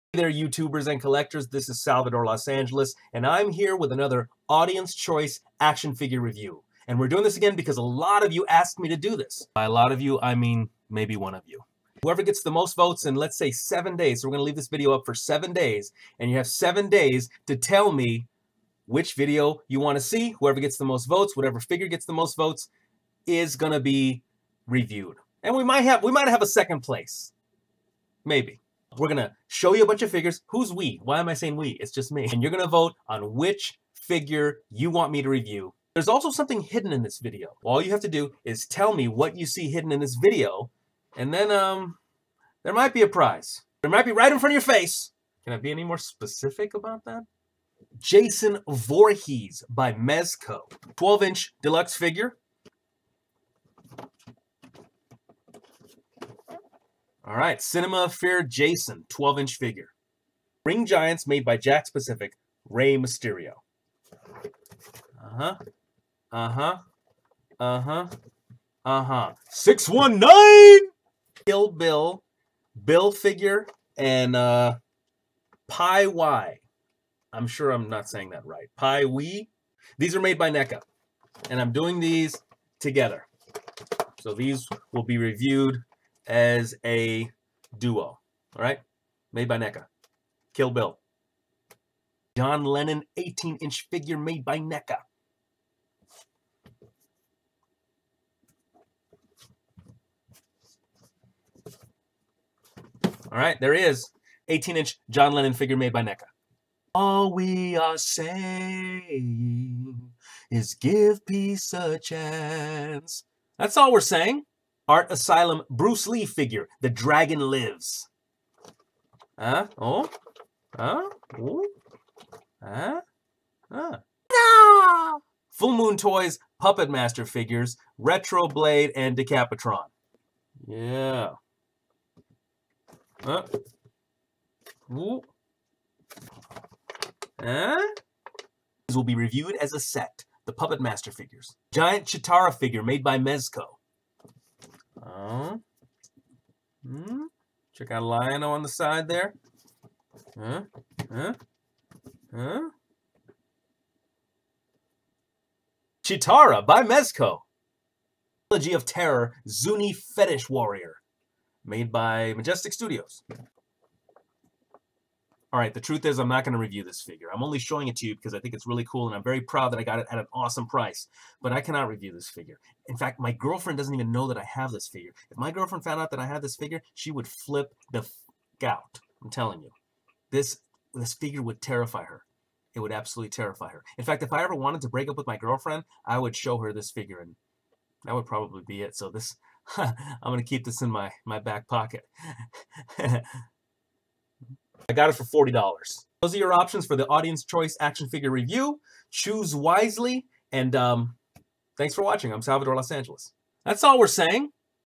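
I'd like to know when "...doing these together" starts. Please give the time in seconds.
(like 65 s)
81 s.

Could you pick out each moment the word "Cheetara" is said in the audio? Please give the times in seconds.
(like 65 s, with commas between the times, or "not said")
142 s, 156 s.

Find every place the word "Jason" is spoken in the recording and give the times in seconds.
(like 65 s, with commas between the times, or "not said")
47 s, 58 s.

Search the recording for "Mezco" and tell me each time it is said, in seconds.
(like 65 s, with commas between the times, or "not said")
49 s, 143 s, 156 s.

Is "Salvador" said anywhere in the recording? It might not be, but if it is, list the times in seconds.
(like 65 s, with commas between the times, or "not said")
1 s, 202 s.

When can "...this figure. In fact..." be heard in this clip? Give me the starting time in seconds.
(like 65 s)
172 s.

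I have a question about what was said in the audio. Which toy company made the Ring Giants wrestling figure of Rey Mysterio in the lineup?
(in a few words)
Jakks Pacific.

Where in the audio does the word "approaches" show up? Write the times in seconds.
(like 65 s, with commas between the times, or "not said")
not said.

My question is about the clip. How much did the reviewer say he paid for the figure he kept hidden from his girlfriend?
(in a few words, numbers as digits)
$40.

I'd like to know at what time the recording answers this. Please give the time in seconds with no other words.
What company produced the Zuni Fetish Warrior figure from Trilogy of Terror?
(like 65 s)
162 s.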